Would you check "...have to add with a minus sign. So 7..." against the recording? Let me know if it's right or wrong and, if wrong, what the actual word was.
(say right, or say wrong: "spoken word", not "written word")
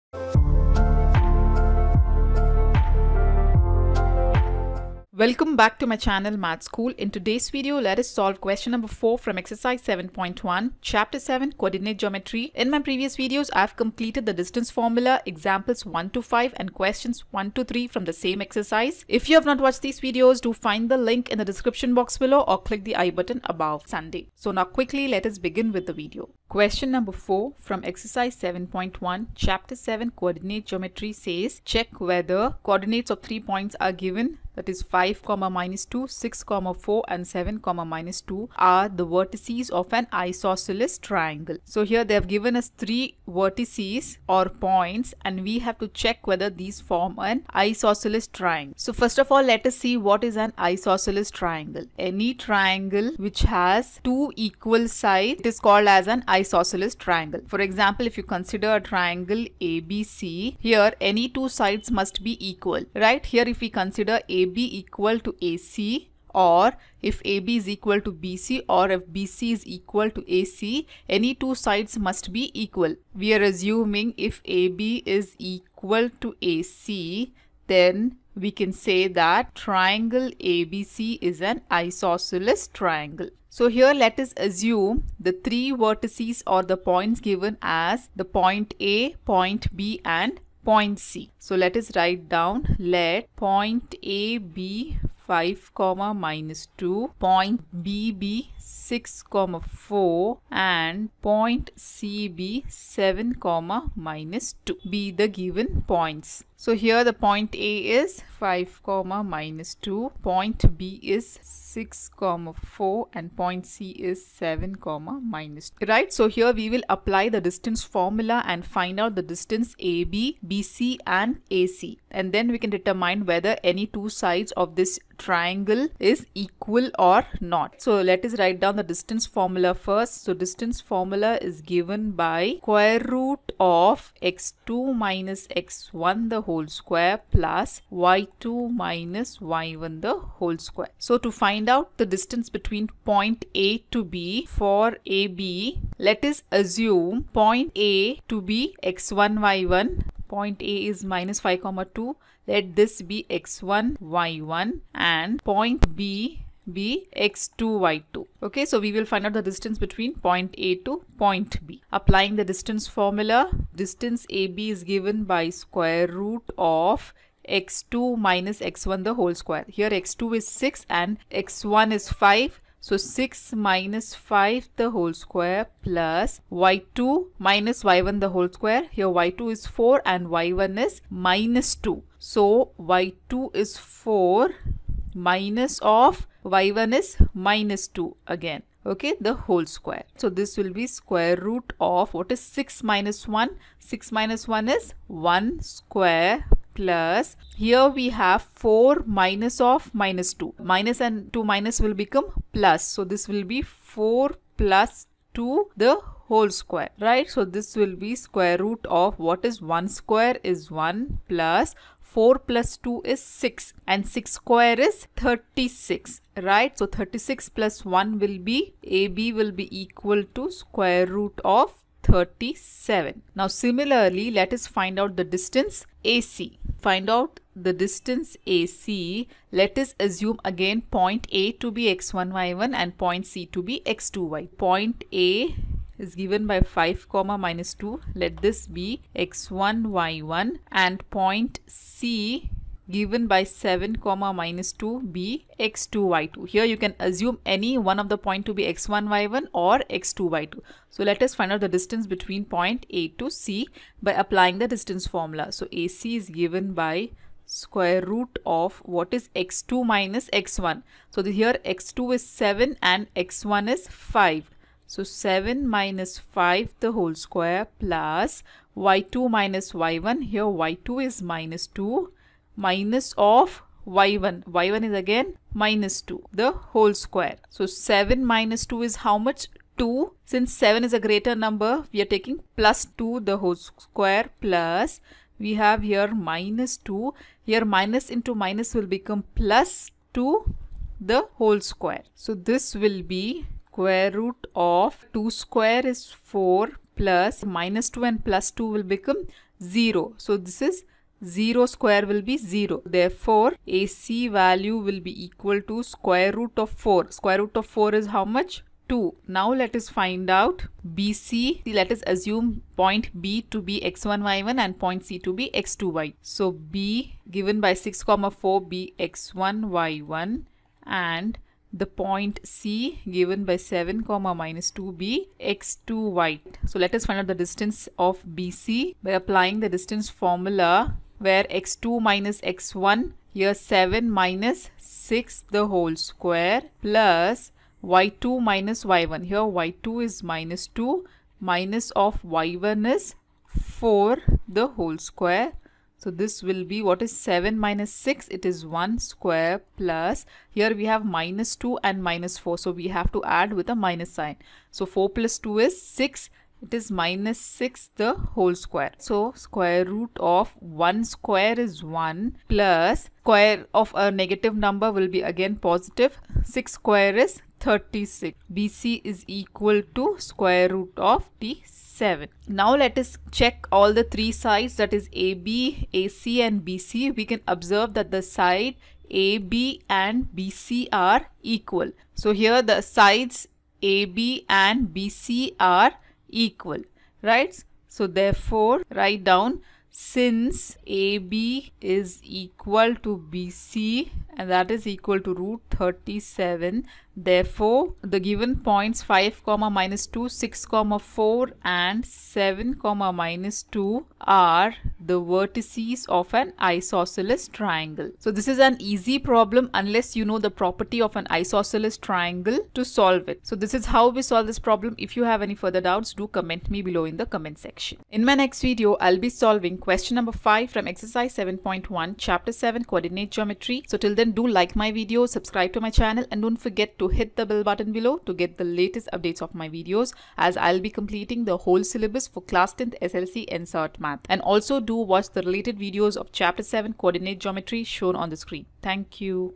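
wrong: "4", not "7".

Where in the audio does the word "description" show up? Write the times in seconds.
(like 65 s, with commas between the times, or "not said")
21 s.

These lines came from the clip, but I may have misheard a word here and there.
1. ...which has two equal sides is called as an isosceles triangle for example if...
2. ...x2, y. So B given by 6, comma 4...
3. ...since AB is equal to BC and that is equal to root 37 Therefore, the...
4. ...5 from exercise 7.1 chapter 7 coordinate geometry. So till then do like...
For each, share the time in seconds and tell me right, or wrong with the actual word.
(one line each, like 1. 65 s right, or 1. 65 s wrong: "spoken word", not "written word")
1. 53 s right
2. 315 s right
3. 389 s right
4. 420 s right.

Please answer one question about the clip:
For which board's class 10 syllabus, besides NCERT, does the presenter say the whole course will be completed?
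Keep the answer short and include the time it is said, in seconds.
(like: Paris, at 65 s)
SSLC, at 433 s.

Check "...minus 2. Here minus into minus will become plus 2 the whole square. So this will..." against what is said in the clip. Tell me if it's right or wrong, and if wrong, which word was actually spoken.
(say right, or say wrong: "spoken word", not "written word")
right.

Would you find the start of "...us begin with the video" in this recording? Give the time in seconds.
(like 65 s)
25 s.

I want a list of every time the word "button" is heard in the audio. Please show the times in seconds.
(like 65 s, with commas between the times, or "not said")
23 s, 427 s.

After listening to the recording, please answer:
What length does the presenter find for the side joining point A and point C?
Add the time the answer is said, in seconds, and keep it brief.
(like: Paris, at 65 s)
2, at 307 s.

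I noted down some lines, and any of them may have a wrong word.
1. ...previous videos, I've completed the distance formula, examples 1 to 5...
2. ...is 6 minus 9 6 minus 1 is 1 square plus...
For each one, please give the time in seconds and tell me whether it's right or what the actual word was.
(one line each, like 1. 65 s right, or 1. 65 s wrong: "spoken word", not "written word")
1. 12 s right
2. 192 s wrong: "1", not "9".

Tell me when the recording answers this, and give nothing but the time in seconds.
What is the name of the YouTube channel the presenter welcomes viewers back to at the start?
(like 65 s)
6 s.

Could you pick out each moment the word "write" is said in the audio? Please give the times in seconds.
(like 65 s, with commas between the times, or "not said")
91 s, 128 s, 388 s.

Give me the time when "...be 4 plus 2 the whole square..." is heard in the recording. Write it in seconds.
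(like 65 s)
203 s.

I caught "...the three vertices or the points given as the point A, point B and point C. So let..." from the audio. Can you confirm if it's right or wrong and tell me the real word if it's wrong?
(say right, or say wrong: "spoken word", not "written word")
right.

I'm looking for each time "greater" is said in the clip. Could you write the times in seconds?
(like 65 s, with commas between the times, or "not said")
280 s.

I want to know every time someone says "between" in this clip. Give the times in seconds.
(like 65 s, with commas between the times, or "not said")
142 s, 159 s, 252 s.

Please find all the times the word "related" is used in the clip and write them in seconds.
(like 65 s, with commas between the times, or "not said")
435 s.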